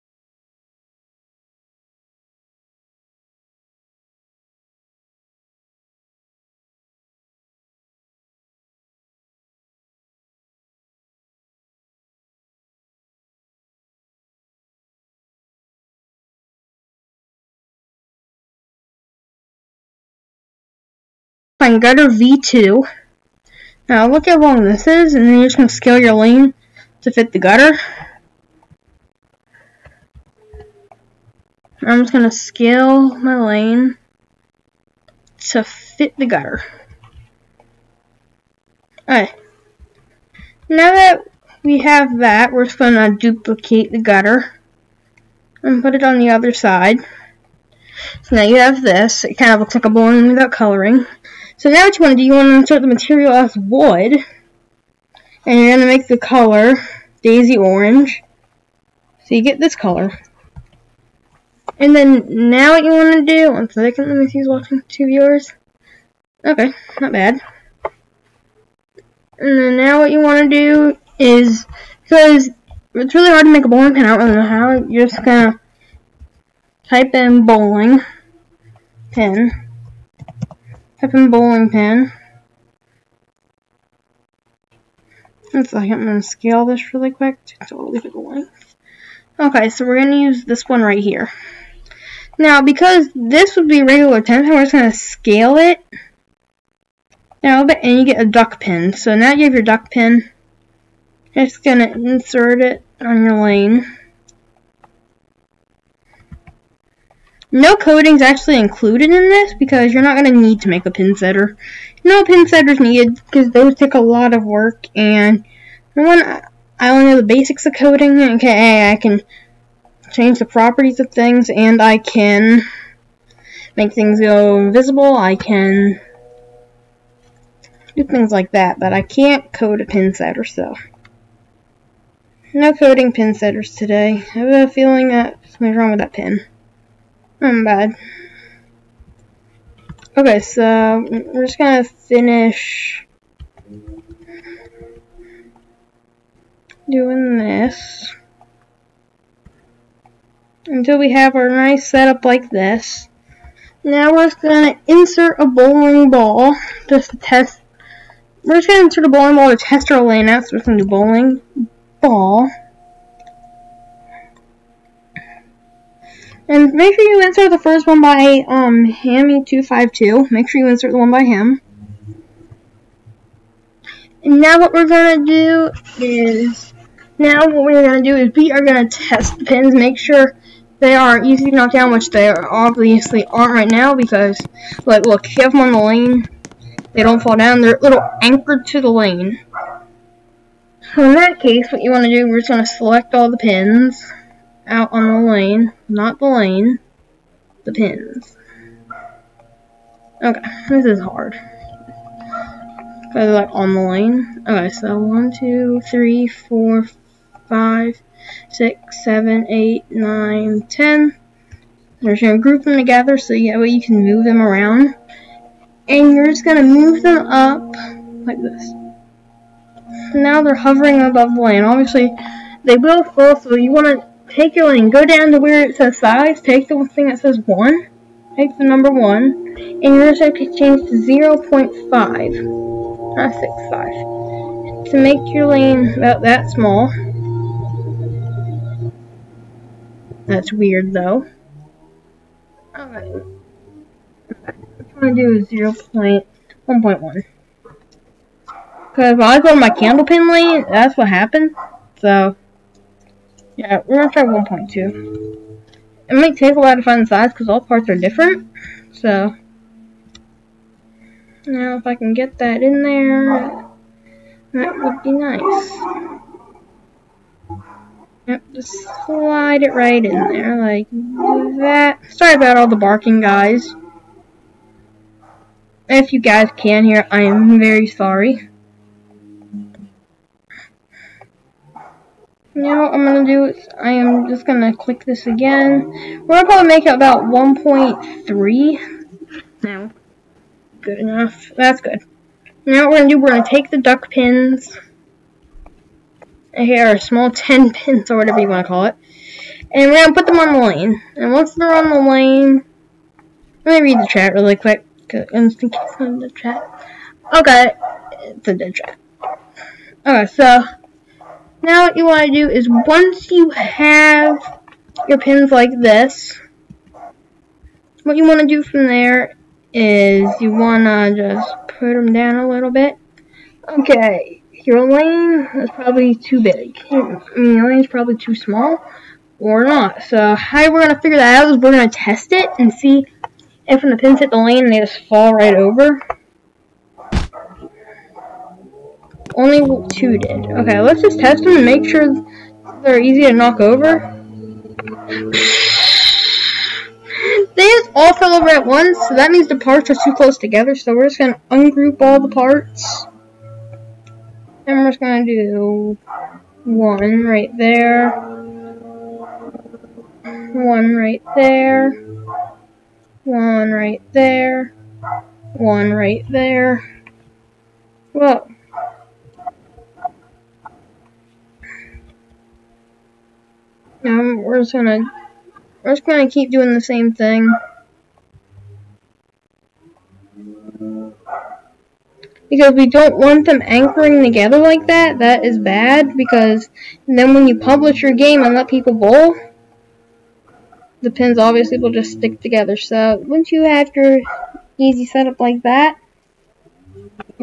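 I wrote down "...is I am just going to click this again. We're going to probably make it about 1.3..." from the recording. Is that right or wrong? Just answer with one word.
right.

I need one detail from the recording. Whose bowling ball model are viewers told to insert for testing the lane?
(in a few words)
Hammy252.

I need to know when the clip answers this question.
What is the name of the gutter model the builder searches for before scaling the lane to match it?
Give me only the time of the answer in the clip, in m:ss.
0:21.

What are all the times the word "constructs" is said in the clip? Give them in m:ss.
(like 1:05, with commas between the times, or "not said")
not said.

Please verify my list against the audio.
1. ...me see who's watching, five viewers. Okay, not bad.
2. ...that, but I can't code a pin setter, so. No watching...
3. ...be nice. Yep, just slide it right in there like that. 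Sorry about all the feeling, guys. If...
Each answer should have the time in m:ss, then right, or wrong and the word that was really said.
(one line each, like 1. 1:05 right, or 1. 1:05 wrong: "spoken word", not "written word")
1. 1:04 wrong: "two", not "five"
2. 2:08 wrong: "coding", not "watching"
3. 4:25 wrong: "barking", not "feeling".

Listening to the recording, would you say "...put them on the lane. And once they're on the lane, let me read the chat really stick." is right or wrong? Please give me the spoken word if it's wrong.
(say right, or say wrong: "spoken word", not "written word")
wrong: "quick", not "stick".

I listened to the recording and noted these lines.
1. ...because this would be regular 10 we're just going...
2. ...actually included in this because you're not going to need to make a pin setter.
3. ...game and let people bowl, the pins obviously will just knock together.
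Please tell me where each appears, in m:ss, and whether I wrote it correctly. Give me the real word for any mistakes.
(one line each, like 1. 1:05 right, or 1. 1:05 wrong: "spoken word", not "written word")
1. 1:32 right
2. 1:48 right
3. 6:28 wrong: "stick", not "knock".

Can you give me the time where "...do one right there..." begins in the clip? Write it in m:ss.
5:55.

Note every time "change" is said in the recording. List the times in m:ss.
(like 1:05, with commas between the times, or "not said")
2:00, 3:50.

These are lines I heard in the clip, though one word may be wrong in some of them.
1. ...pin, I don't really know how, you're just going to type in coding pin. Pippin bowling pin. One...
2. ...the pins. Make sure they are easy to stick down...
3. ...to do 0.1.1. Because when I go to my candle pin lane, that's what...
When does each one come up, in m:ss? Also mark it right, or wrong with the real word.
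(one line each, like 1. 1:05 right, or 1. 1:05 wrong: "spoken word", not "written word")
1. 1:13 wrong: "bowling", not "coding"
2. 2:59 wrong: "knock", not "stick"
3. 4:05 right.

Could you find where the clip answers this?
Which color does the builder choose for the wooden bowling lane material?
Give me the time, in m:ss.
0:57.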